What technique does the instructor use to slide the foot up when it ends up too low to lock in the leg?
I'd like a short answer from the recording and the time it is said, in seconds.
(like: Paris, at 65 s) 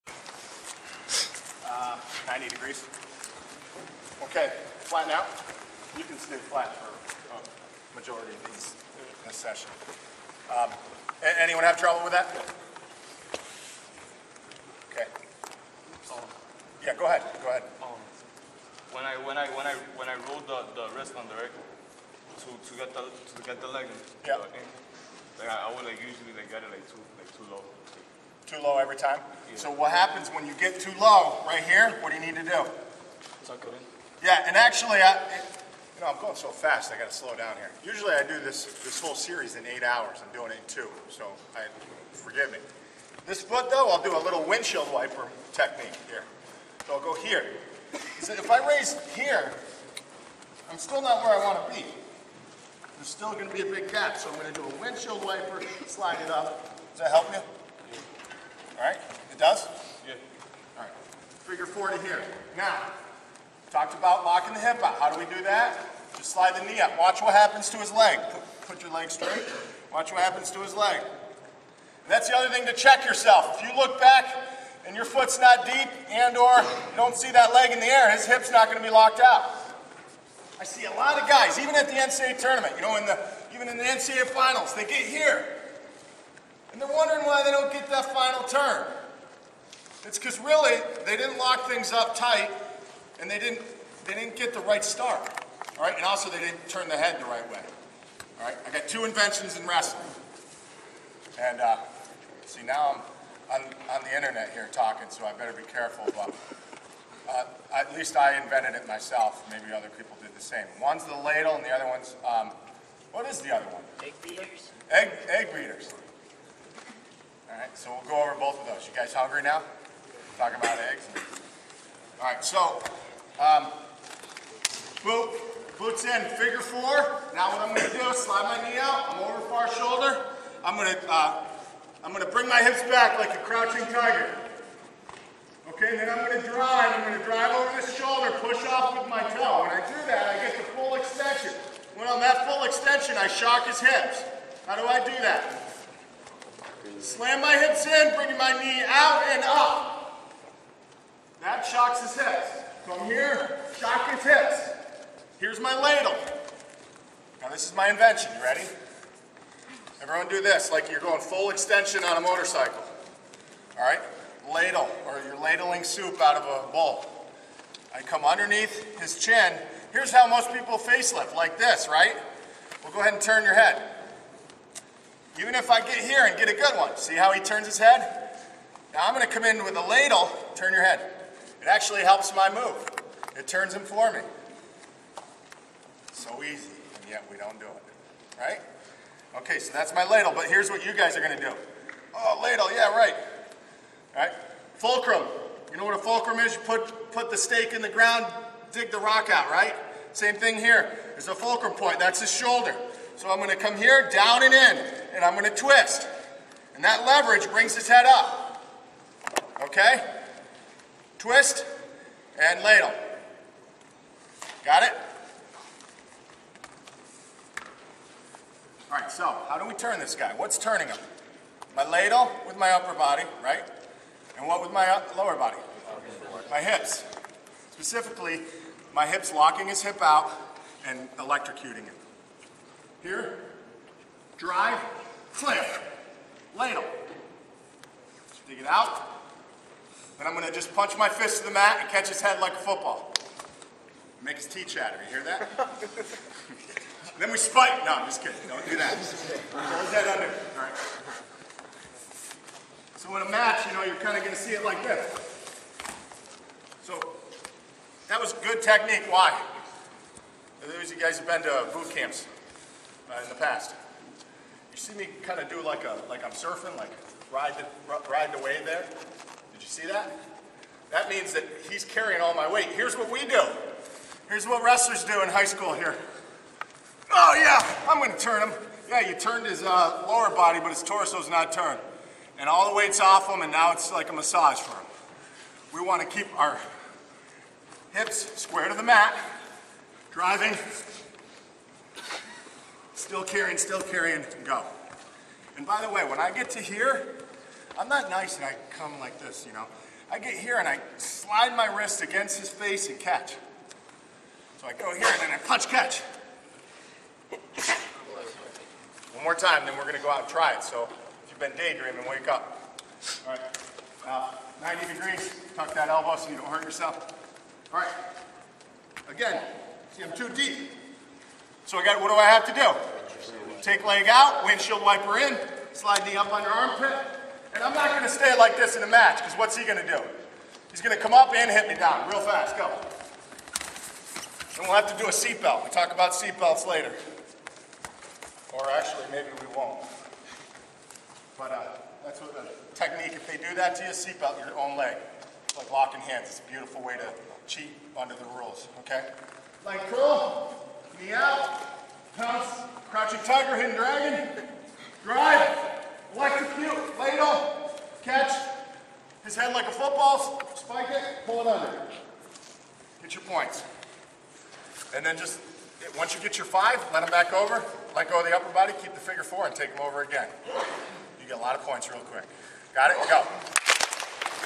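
windshield wiper technique, at 44 s.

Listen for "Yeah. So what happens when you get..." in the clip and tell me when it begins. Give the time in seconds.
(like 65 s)
29 s.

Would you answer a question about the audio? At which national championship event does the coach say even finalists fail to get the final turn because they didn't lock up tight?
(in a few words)
NCAA finals.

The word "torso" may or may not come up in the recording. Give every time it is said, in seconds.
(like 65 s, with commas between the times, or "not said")
280 s.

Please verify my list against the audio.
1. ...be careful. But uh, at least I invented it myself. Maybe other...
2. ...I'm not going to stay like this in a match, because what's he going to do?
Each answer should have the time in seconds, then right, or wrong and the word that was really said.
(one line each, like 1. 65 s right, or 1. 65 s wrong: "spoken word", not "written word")
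1. 105 s right
2. 327 s right.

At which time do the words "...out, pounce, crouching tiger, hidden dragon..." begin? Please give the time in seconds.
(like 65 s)
351 s.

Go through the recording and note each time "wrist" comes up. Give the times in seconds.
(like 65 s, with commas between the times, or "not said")
20 s, 301 s.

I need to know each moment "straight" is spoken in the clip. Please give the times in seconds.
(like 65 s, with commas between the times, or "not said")
69 s.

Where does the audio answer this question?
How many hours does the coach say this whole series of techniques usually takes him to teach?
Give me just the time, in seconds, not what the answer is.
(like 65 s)
39 s.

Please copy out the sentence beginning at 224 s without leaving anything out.
And what with my uh, lower body?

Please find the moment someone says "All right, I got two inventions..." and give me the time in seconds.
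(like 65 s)
98 s.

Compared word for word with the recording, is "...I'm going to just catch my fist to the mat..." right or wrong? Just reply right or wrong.
wrong.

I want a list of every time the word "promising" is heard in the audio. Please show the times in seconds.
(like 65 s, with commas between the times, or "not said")
not said.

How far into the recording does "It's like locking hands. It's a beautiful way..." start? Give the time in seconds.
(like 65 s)
345 s.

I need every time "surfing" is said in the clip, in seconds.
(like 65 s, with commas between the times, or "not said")
266 s.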